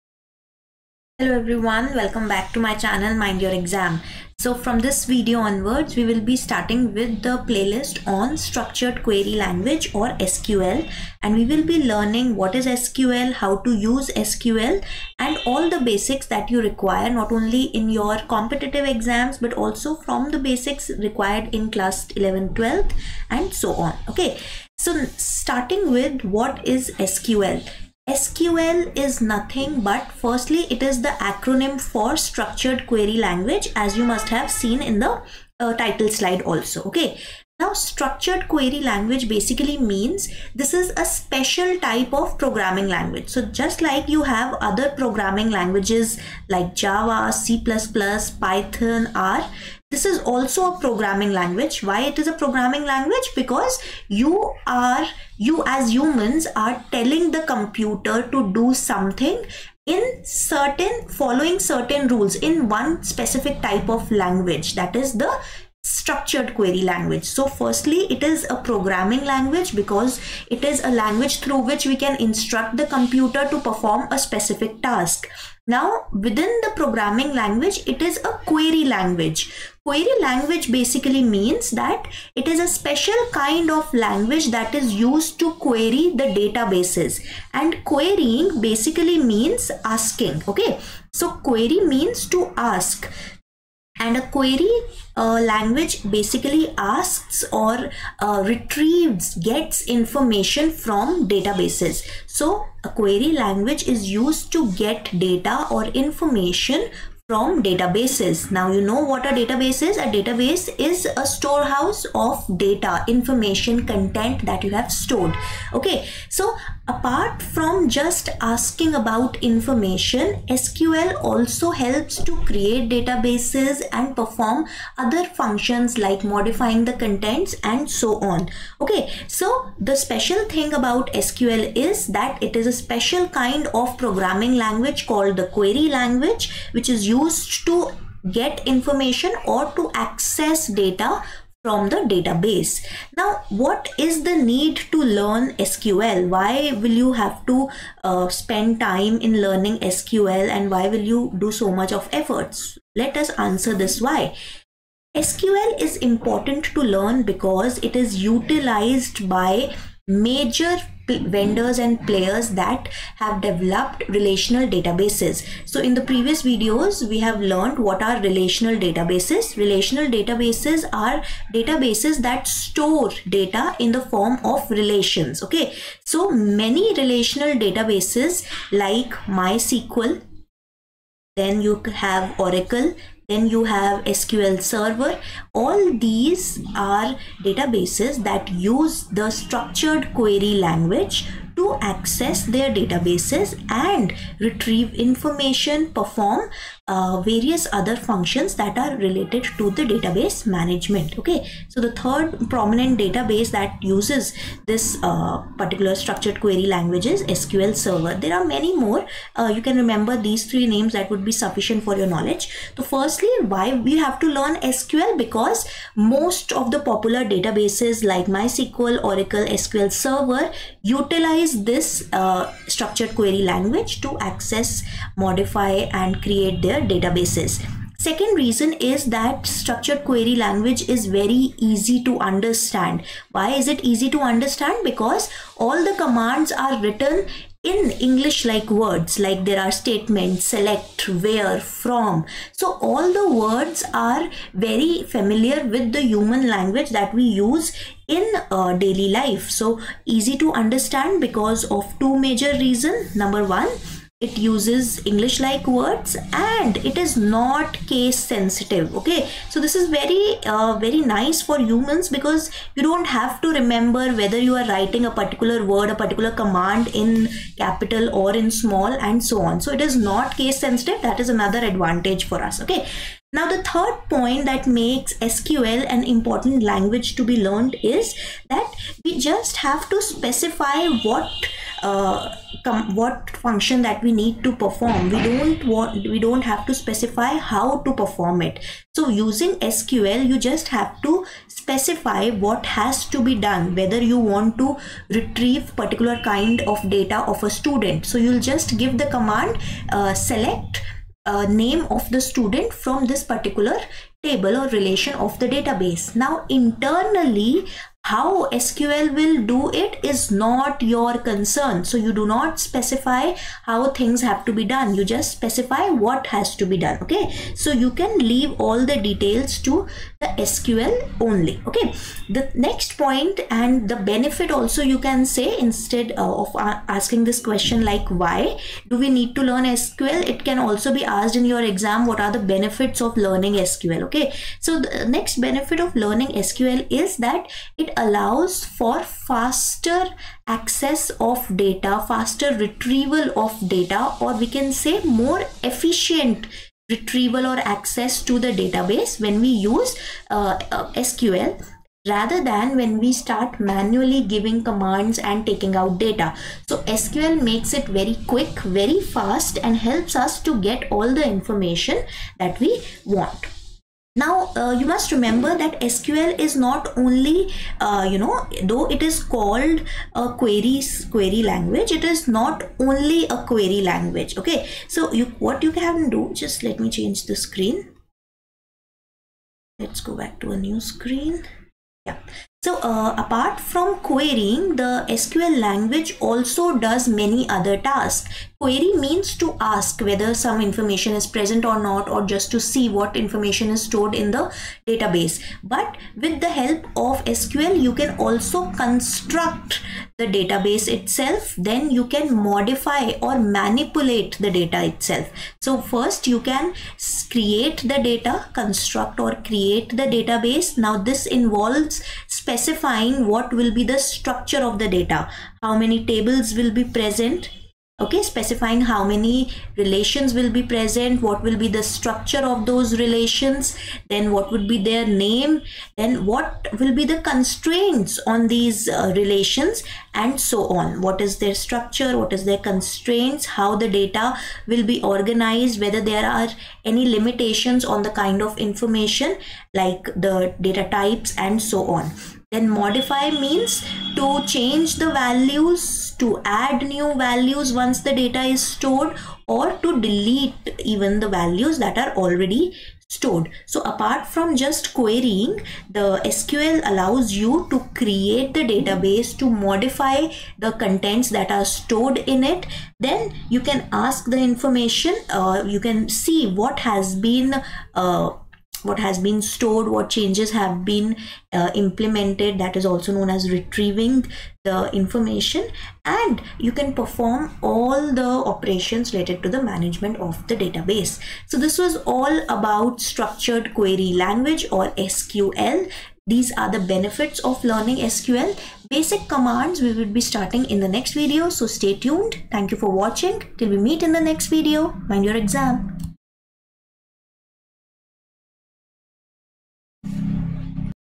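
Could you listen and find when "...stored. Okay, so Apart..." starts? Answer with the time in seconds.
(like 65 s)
114 s.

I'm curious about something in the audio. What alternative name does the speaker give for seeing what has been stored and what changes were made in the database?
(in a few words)
retrieving the information.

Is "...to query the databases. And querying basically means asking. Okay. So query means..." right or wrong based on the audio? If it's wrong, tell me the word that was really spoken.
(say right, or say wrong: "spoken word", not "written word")
right.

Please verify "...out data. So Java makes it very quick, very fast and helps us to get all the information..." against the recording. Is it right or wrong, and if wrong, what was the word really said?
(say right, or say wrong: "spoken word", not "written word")
wrong: "SQL", not "Java".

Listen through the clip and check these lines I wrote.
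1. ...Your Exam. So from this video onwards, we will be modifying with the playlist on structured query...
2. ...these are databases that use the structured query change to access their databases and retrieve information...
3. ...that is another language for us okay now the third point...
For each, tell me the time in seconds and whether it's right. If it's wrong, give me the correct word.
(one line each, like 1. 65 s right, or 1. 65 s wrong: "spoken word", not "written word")
1. 3 s wrong: "starting", not "modifying"
2. 186 s wrong: "language", not "change"
3. 271 s wrong: "advantage", not "language".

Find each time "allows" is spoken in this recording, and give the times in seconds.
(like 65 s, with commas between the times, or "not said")
338 s, 456 s.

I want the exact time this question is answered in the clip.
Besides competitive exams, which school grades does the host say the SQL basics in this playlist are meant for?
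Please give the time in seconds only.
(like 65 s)
21 s.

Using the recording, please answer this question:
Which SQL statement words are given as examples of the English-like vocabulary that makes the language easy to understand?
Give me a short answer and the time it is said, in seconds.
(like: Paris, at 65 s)
select, where, from, at 240 s.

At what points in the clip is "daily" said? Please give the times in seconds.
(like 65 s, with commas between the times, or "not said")
248 s.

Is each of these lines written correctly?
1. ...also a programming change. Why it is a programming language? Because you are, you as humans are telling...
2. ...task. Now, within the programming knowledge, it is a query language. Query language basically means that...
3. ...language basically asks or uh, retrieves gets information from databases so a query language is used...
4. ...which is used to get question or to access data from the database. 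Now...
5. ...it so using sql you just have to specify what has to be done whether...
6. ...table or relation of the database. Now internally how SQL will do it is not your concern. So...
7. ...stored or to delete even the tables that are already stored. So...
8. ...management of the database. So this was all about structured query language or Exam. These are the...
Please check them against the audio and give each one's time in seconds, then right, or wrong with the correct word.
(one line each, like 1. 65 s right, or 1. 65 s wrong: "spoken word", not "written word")
1. 50 s wrong: "language", not "change"
2. 74 s wrong: "language", not "knowledge"
3. 95 s right
4. 136 s wrong: "information", not "question"
5. 288 s right
6. 304 s right
7. 448 s wrong: "values", not "tables"
8. 479 s wrong: "SQL", not "Exam".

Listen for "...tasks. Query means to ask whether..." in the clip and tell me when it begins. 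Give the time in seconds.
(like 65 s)
387 s.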